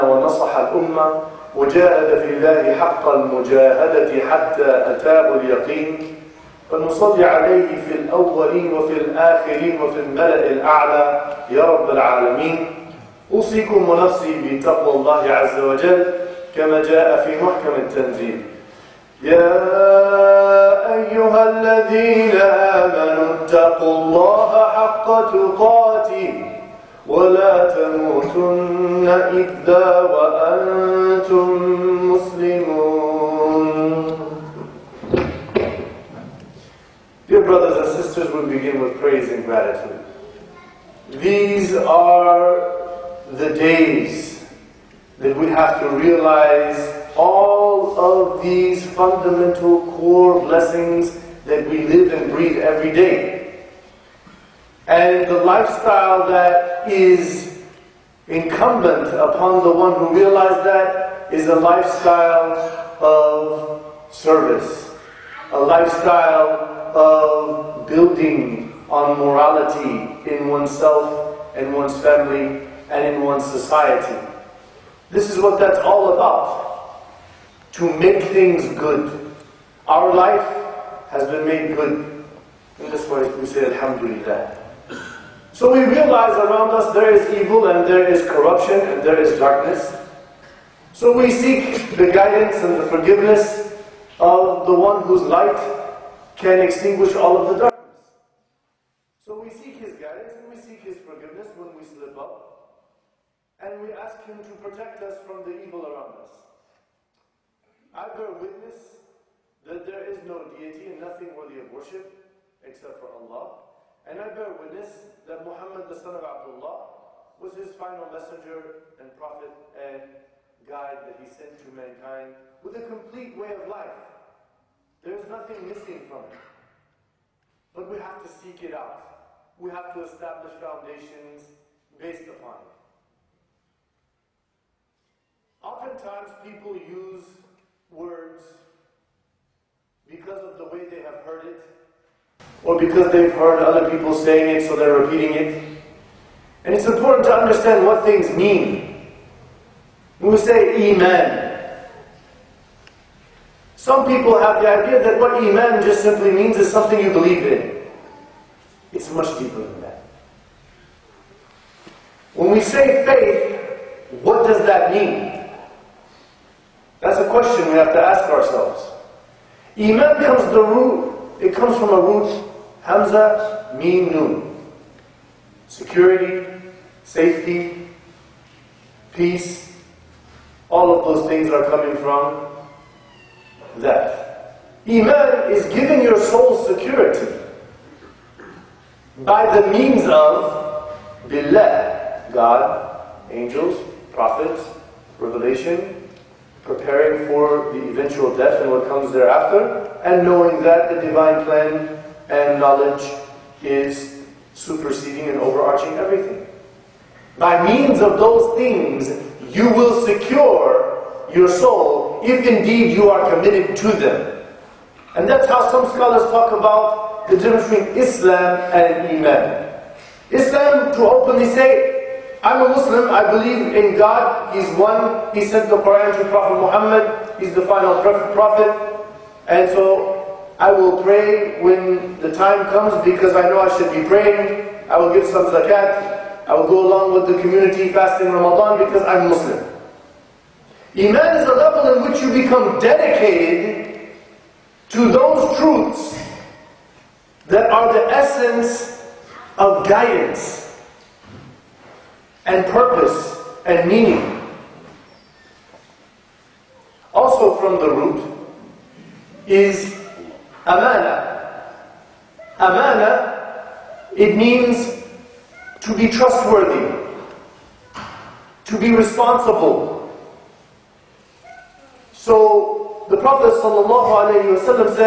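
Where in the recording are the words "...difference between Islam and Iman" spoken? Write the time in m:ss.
3:37.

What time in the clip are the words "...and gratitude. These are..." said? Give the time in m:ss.
0:39.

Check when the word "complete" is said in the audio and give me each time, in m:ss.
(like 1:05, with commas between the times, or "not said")
2:02.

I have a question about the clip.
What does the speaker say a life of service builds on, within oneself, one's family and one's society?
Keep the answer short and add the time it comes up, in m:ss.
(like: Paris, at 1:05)
morality, at 1:09.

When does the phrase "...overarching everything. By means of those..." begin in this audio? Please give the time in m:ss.
3:25.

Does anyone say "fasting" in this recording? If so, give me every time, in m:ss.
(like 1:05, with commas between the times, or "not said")
3:57.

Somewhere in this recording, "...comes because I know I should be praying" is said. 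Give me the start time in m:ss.
3:52.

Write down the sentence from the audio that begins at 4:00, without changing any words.
Iman is a level in which you become dedicated to those truths that are the essence of guidance and purpose and meaning.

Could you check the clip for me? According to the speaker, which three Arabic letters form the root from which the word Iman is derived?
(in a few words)
Hamza, Mim, Nun.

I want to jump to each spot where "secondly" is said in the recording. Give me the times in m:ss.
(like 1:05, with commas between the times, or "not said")
not said.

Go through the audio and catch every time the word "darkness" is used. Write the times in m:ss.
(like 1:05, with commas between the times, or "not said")
1:29, 1:37.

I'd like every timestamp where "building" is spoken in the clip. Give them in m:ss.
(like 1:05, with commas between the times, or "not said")
1:07.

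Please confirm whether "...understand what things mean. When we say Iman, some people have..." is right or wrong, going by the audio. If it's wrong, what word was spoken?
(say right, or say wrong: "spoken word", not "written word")
right.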